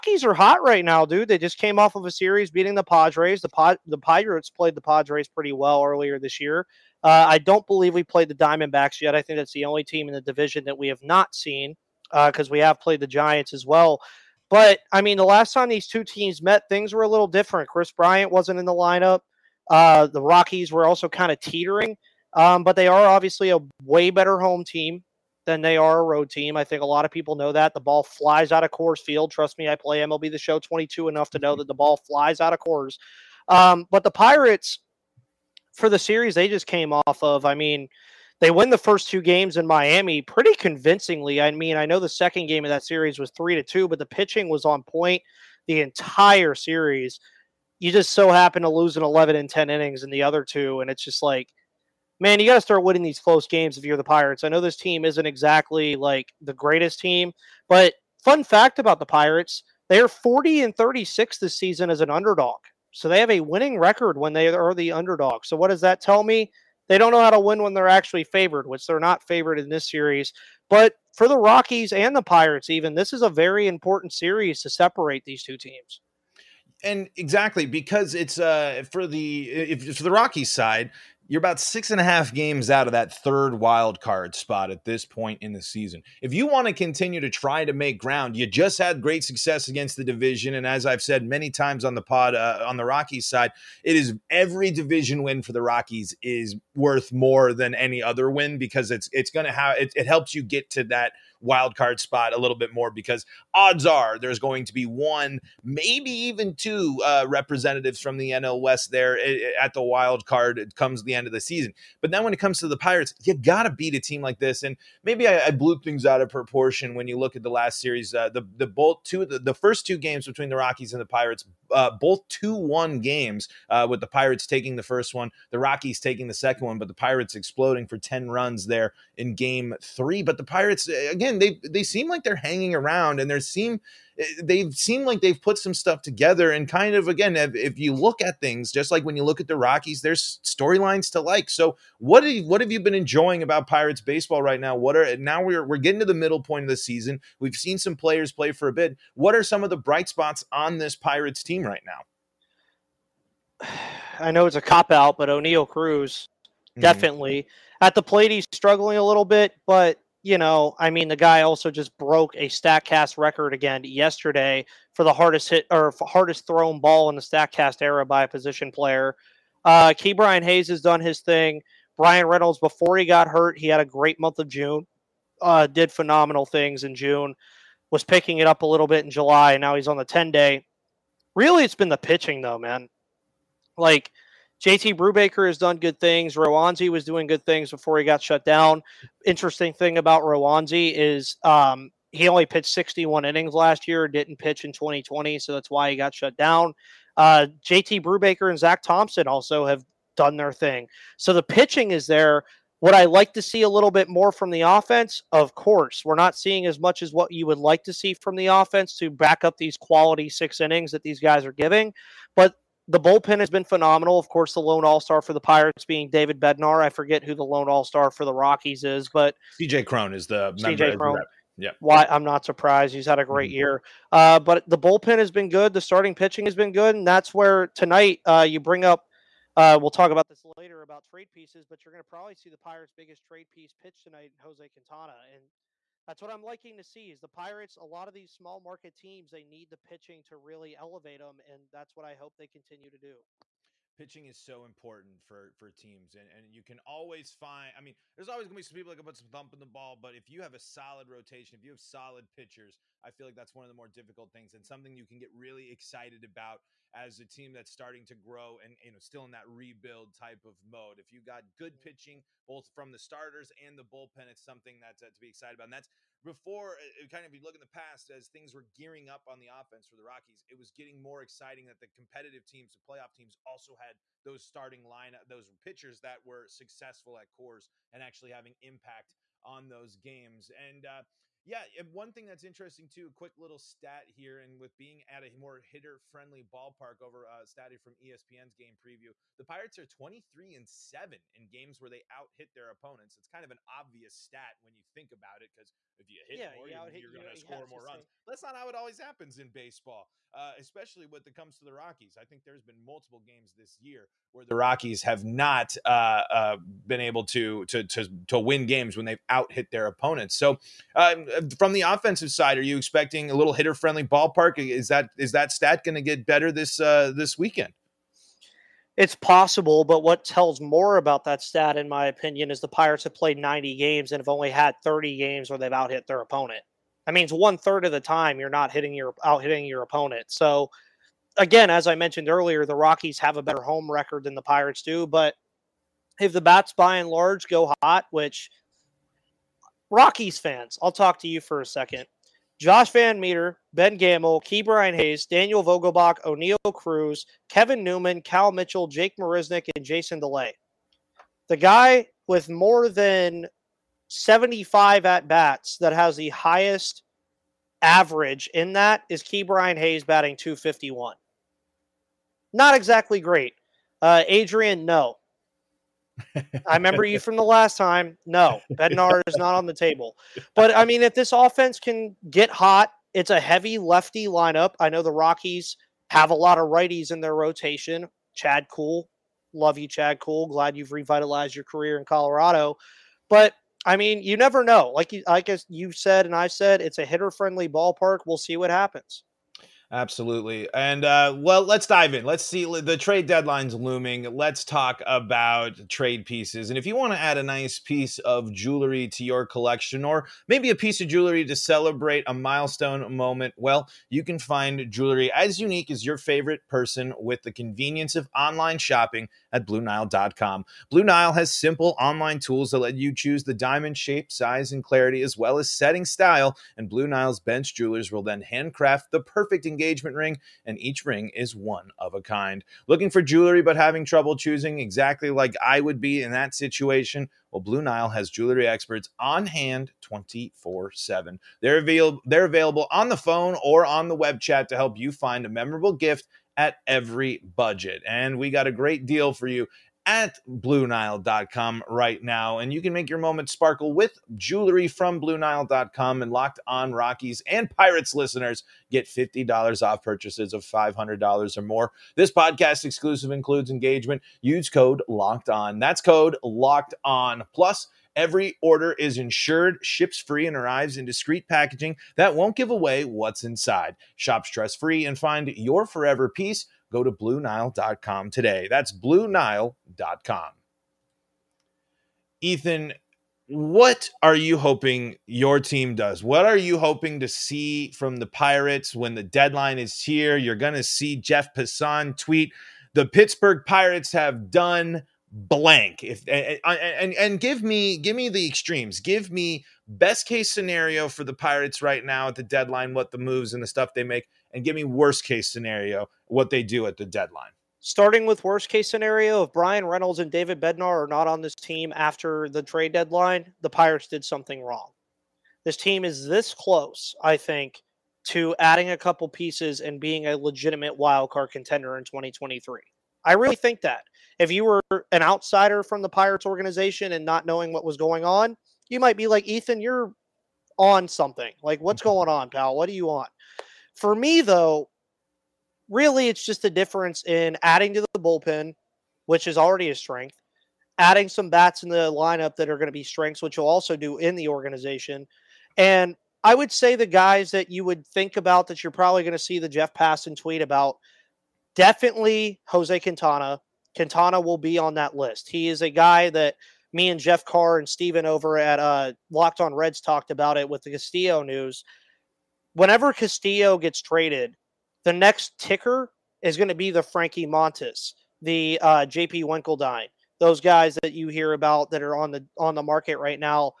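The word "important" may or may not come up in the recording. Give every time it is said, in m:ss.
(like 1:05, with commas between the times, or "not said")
1:13, 4:04.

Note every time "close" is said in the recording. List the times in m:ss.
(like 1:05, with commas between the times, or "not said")
0:53, 8:26.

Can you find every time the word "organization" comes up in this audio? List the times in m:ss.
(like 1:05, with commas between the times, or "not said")
8:36, 8:54.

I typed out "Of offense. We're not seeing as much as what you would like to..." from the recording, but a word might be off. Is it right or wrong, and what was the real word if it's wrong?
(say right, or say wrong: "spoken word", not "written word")
wrong: "course", not "offense".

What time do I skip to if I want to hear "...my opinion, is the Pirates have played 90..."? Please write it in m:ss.
5:21.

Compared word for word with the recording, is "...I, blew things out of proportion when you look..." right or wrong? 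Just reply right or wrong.
right.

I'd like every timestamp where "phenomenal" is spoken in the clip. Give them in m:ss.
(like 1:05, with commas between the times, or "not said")
2:55, 3:33.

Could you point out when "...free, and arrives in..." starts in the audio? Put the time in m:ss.
7:40.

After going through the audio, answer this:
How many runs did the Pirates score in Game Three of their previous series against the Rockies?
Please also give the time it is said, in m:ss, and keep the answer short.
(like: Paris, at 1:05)
10, at 2:07.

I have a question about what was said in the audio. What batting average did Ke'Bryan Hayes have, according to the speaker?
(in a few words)
251.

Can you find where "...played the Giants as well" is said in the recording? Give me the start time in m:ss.
0:12.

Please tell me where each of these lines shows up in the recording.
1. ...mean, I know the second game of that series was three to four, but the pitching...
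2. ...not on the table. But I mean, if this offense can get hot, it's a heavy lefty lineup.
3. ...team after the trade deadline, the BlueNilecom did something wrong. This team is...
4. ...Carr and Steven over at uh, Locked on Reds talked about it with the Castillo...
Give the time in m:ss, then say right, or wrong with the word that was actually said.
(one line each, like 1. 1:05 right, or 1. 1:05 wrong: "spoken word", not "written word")
1. 0:41 wrong: "two", not "four"
2. 6:09 right
3. 8:21 wrong: "Pirates", not "BlueNilecom"
4. 9:07 right.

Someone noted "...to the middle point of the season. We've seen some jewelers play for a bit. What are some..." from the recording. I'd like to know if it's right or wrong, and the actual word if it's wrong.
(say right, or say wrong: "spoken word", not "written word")
wrong: "players", not "jewelers".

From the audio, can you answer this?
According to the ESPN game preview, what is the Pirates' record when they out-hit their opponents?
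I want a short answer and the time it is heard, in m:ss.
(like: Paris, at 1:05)
23 and 7, at 4:49.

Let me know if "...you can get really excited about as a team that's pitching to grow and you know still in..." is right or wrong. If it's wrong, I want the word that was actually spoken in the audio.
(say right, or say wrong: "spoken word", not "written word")
wrong: "starting", not "pitching".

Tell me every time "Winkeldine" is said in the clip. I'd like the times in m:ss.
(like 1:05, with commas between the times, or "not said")
9:19.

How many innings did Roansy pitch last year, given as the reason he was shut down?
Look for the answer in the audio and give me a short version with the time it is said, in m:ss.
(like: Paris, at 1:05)
61, at 3:12.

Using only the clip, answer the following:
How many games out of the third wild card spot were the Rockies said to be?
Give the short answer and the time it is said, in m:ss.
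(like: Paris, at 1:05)
six and a half, at 1:21.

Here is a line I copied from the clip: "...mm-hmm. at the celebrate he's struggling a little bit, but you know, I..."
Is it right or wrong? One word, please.
wrong.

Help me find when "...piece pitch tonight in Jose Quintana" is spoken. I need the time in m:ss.
3:53.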